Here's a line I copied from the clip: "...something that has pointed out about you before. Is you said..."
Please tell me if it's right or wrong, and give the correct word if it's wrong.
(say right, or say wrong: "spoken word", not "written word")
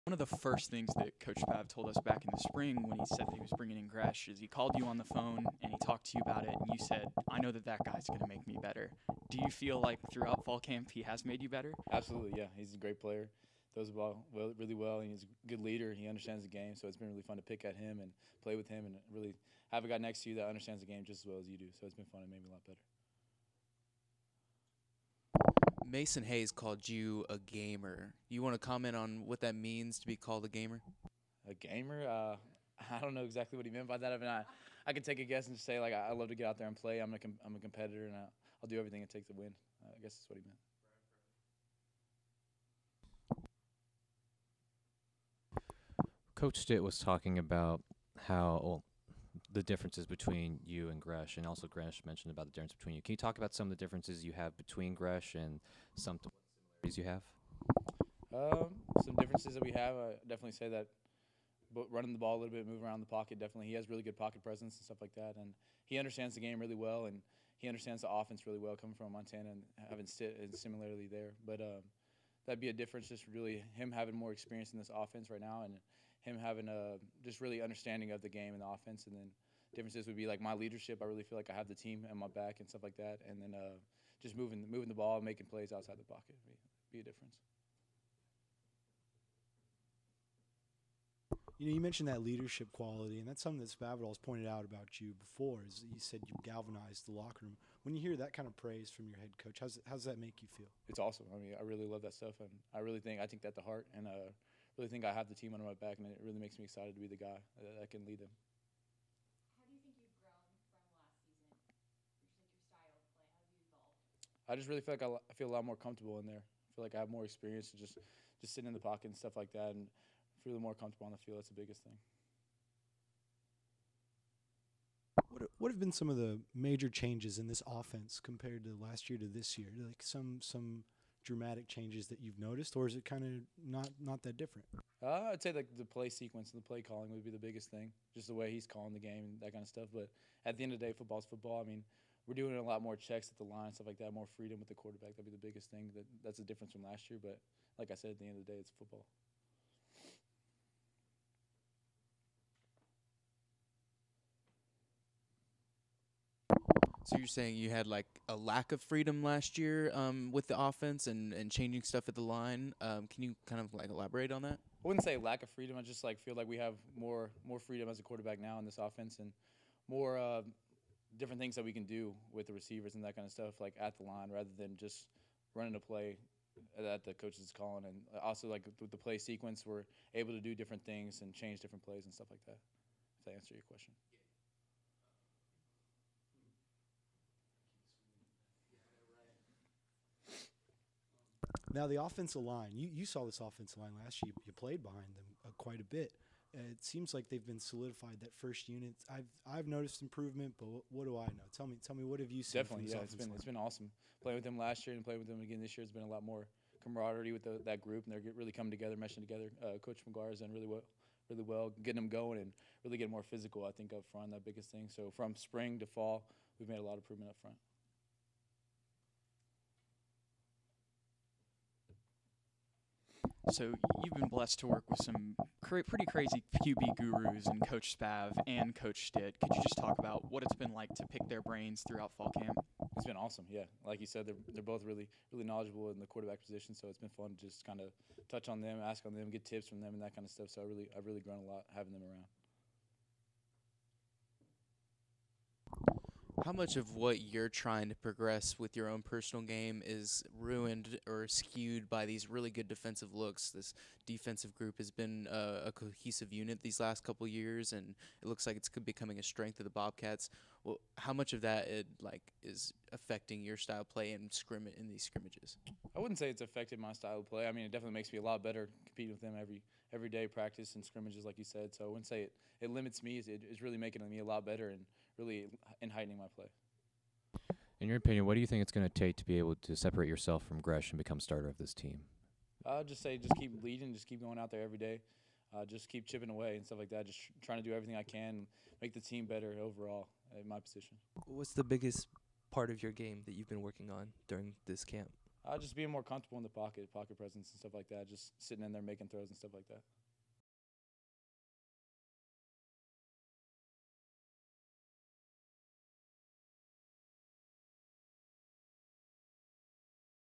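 right.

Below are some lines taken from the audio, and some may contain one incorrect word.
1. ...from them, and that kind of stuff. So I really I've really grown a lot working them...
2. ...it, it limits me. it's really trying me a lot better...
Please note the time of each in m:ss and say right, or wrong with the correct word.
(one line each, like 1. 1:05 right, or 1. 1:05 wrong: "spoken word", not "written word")
1. 3:59 wrong: "having", not "working"
2. 4:32 wrong: "making", not "trying".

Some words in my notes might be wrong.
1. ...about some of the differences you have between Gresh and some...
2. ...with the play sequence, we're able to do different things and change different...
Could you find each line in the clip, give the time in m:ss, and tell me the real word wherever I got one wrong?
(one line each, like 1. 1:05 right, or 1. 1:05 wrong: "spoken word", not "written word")
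1. 0:53 right
2. 2:58 right.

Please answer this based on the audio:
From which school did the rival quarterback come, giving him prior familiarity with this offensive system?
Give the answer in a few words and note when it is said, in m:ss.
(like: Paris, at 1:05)
Montana, at 1:09.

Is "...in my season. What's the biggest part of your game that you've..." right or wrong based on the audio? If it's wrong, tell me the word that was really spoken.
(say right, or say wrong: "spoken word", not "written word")
wrong: "position", not "season".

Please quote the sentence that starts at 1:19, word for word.
And then differences would be like my leadership.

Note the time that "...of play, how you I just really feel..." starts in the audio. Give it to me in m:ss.
1:52.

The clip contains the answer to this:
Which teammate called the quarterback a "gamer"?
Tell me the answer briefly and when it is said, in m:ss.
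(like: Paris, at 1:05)
Mason Hayes, at 0:25.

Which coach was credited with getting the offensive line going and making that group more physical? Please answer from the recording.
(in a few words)
Coach McGuire.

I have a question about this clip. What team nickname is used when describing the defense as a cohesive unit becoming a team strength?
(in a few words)
Bobcats.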